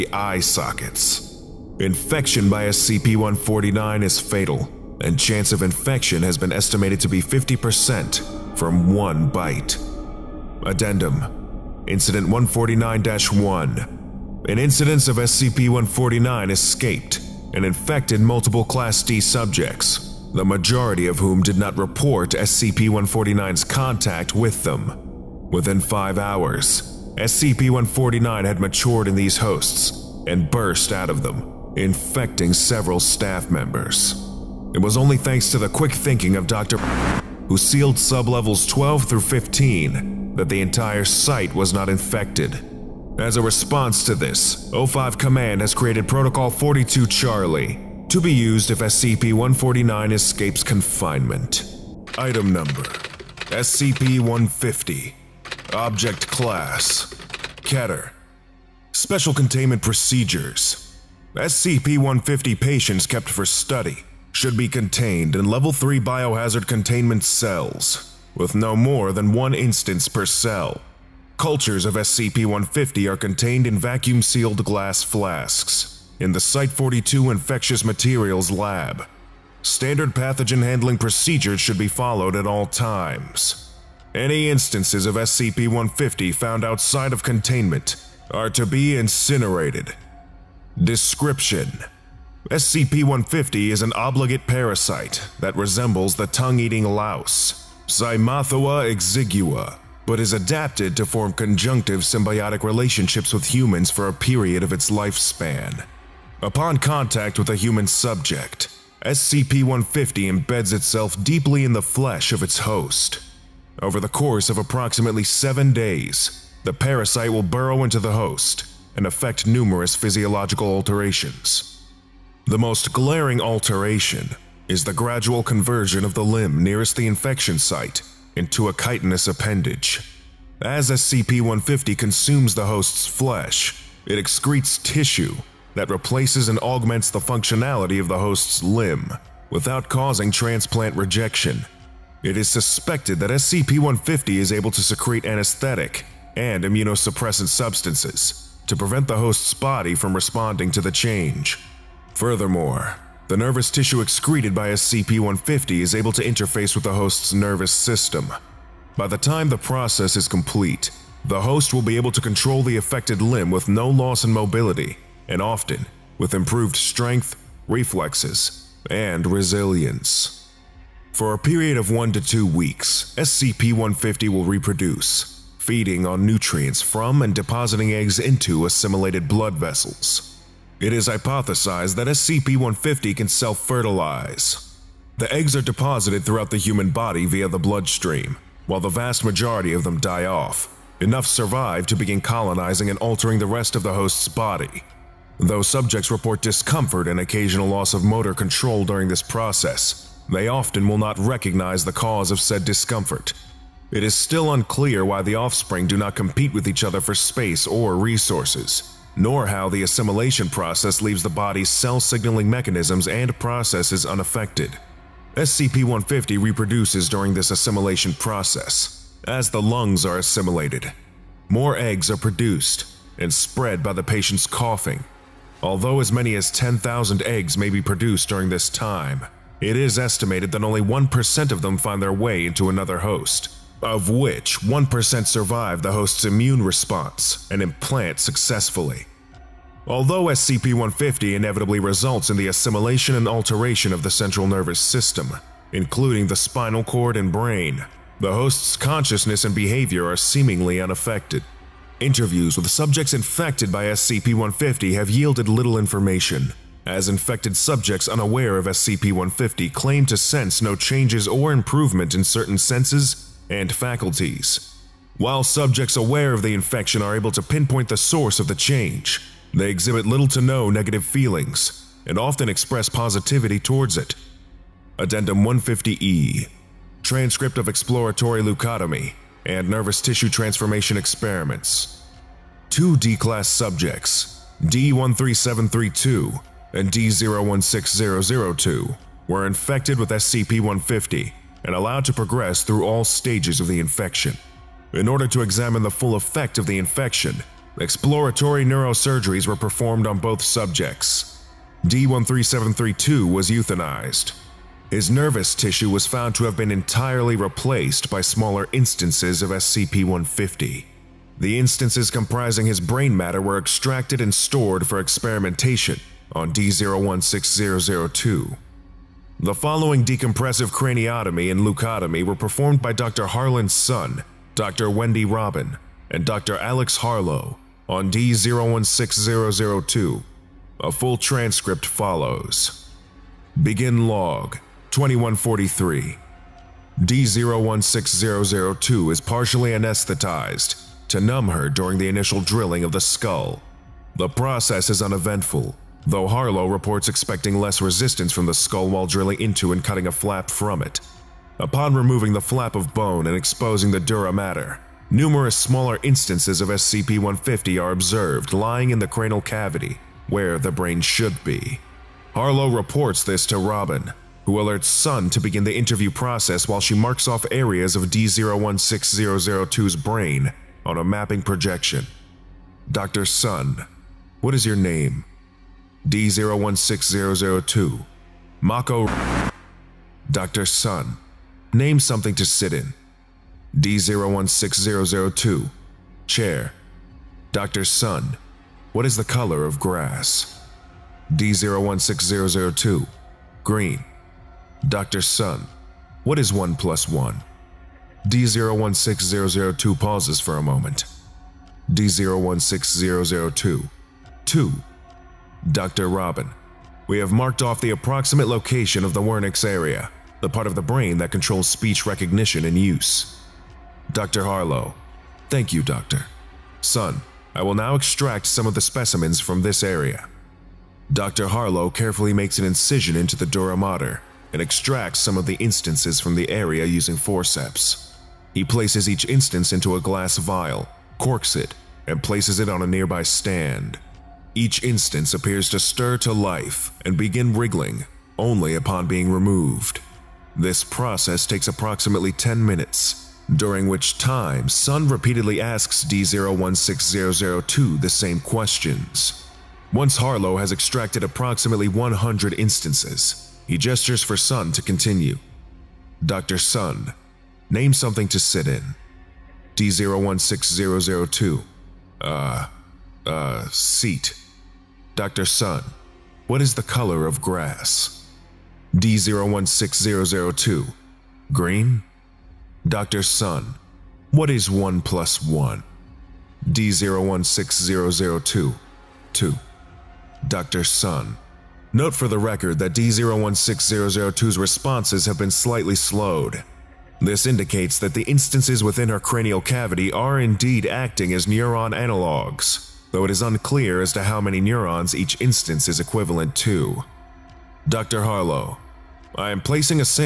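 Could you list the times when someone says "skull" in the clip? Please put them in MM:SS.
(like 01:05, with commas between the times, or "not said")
05:42, 05:48.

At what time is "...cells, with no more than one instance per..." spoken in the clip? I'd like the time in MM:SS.
01:07.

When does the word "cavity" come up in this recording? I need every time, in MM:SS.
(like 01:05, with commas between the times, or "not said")
05:59, 08:09.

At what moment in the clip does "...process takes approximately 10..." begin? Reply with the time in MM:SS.
07:20.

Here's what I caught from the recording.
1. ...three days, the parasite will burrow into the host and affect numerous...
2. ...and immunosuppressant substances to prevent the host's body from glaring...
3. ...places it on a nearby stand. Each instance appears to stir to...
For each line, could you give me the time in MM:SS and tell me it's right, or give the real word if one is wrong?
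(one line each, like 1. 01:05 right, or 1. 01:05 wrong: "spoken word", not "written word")
1. 01:55 wrong: "seven", not "three"
2. 02:26 wrong: "responding", not "glaring"
3. 07:12 right.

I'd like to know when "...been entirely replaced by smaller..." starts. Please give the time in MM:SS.
05:06.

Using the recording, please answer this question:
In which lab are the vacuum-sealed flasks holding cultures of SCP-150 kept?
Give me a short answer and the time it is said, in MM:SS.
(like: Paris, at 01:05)
Site 42 Infectious Materials Lab, at 01:16.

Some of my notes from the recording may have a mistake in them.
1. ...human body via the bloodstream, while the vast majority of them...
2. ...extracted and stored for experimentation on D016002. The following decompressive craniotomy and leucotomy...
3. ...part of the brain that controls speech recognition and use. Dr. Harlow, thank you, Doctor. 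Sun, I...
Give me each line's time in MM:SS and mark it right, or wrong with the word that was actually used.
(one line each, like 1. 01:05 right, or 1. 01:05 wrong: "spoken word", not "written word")
1. 03:06 right
2. 05:13 right
3. 06:50 right.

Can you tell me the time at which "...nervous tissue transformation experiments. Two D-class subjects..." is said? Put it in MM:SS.
04:39.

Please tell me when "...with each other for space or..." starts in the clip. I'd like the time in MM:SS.
03:26.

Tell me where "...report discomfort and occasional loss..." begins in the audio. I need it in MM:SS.
03:16.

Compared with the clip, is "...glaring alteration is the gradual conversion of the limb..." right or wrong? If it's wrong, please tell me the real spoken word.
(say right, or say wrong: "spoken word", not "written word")
right.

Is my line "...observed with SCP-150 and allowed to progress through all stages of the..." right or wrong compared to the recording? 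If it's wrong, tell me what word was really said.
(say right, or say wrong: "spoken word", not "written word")
wrong: "infected", not "observed".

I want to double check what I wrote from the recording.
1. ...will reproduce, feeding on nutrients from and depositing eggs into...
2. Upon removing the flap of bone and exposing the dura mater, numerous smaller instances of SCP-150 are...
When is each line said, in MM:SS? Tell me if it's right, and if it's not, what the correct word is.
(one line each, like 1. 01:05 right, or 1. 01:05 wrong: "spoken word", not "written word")
1. 02:54 right
2. 05:51 right.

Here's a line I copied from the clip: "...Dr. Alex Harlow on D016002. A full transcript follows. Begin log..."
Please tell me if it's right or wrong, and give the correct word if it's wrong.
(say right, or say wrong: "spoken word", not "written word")
right.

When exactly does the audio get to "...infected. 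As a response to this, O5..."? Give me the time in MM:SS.
00:41.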